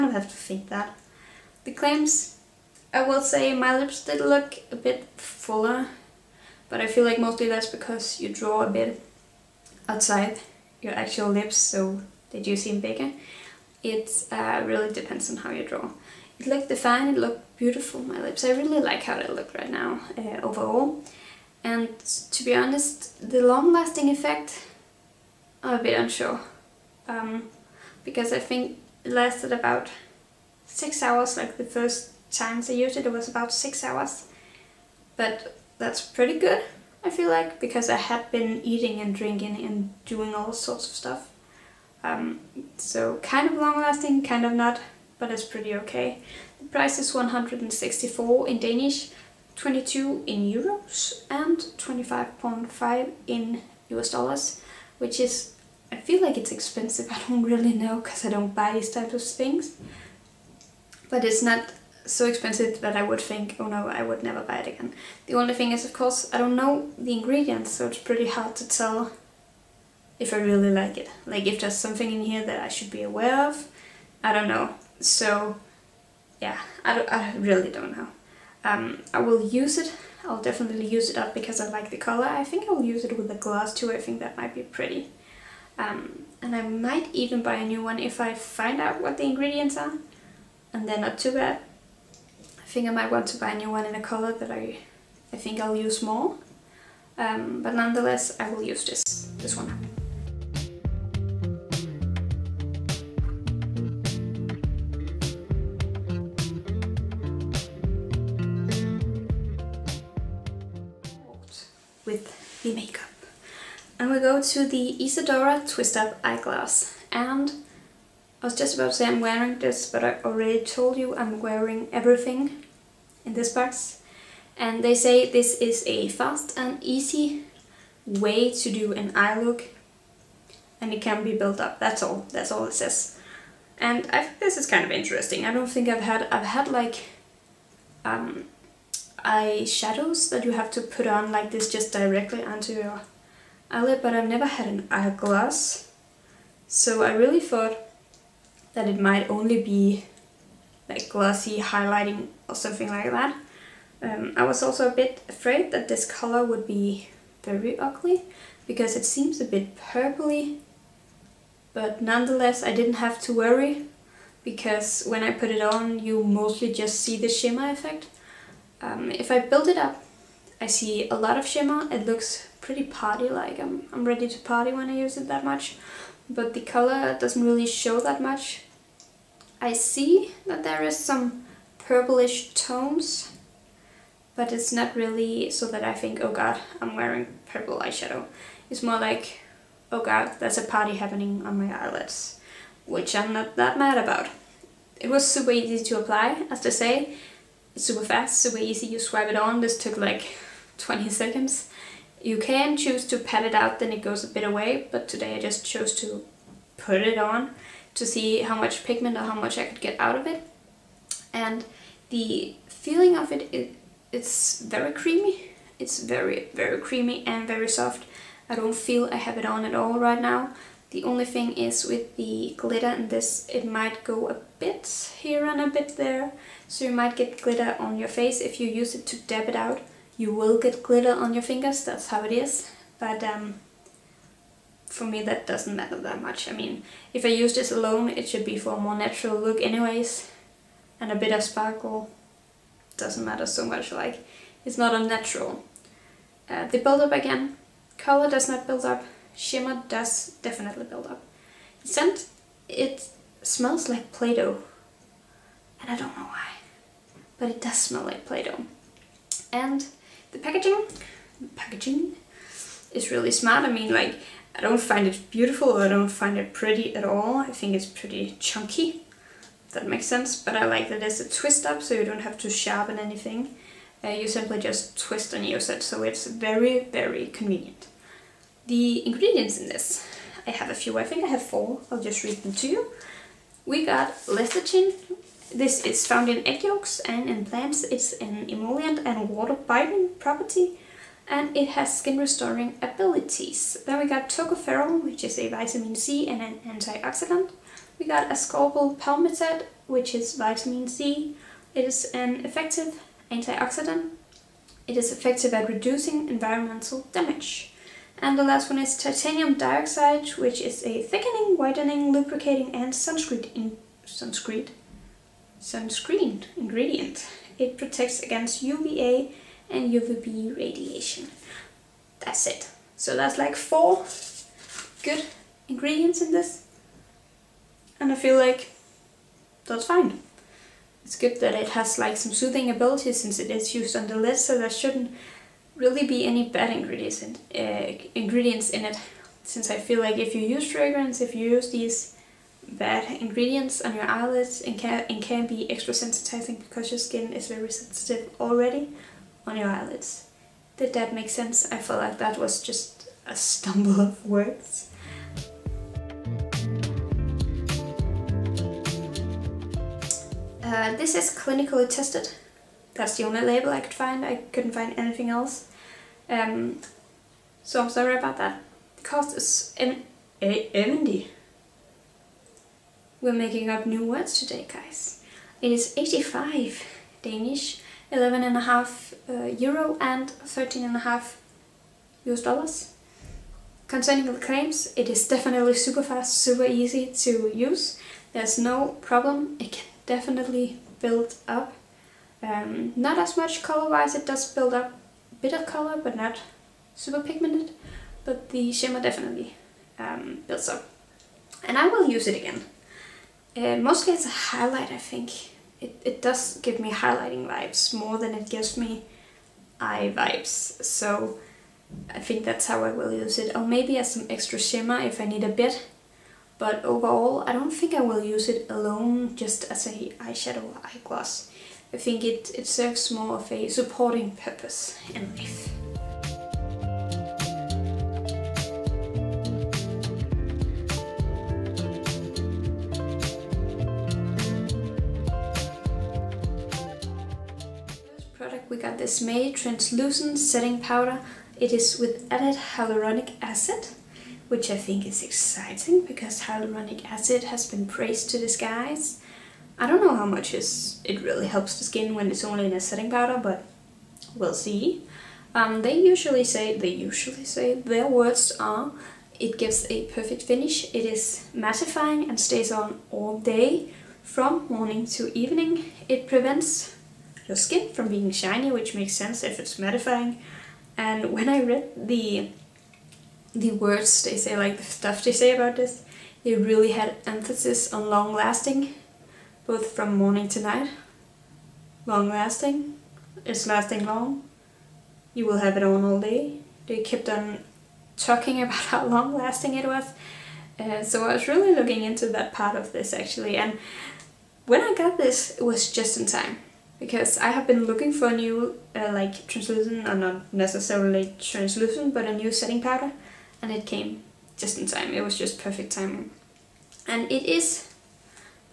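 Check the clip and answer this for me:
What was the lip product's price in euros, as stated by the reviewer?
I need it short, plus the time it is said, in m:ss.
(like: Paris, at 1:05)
22, at 0:49.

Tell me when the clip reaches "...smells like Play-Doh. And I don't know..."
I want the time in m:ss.
4:13.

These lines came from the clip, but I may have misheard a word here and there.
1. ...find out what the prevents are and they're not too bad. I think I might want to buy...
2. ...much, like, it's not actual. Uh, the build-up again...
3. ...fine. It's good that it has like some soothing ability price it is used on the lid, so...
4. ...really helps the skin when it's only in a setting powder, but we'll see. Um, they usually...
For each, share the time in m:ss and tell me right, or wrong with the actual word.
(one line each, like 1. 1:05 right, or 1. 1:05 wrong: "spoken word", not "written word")
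1. 1:28 wrong: "ingredients", not "prevents"
2. 4:03 wrong: "unnatural", not "actual"
3. 5:29 wrong: "since", not "price"
4. 7:31 right.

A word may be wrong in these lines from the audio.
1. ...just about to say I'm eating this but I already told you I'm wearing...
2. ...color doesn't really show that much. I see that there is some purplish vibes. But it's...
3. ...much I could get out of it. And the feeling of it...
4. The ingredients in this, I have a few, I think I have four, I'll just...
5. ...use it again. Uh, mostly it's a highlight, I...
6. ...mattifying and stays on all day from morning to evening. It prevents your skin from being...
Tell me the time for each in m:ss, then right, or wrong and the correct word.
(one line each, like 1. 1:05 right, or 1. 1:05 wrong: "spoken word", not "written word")
1. 1:58 wrong: "wearing", not "eating"
2. 2:56 wrong: "tones", not "vibes"
3. 3:29 right
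4. 4:38 right
5. 6:42 right
6. 7:41 right.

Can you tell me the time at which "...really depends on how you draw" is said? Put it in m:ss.
0:14.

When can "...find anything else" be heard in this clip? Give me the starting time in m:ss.
6:04.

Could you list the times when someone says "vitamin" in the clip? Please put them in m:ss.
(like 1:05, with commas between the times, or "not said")
4:55, 5:00.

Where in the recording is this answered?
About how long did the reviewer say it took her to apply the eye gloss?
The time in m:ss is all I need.
3:20.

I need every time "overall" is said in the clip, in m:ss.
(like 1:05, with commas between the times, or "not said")
0:20, 6:56.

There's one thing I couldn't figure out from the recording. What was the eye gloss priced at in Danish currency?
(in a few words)
85.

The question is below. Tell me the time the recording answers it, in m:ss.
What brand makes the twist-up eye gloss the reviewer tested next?
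1:55.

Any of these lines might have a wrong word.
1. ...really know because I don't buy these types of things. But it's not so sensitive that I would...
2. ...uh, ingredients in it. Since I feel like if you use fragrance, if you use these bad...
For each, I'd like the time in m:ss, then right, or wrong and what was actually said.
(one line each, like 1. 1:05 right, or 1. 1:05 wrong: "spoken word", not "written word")
1. 0:57 wrong: "expensive", not "sensitive"
2. 5:37 right.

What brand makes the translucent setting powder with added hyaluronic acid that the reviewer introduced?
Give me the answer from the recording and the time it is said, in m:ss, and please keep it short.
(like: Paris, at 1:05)
MAYY, at 7:19.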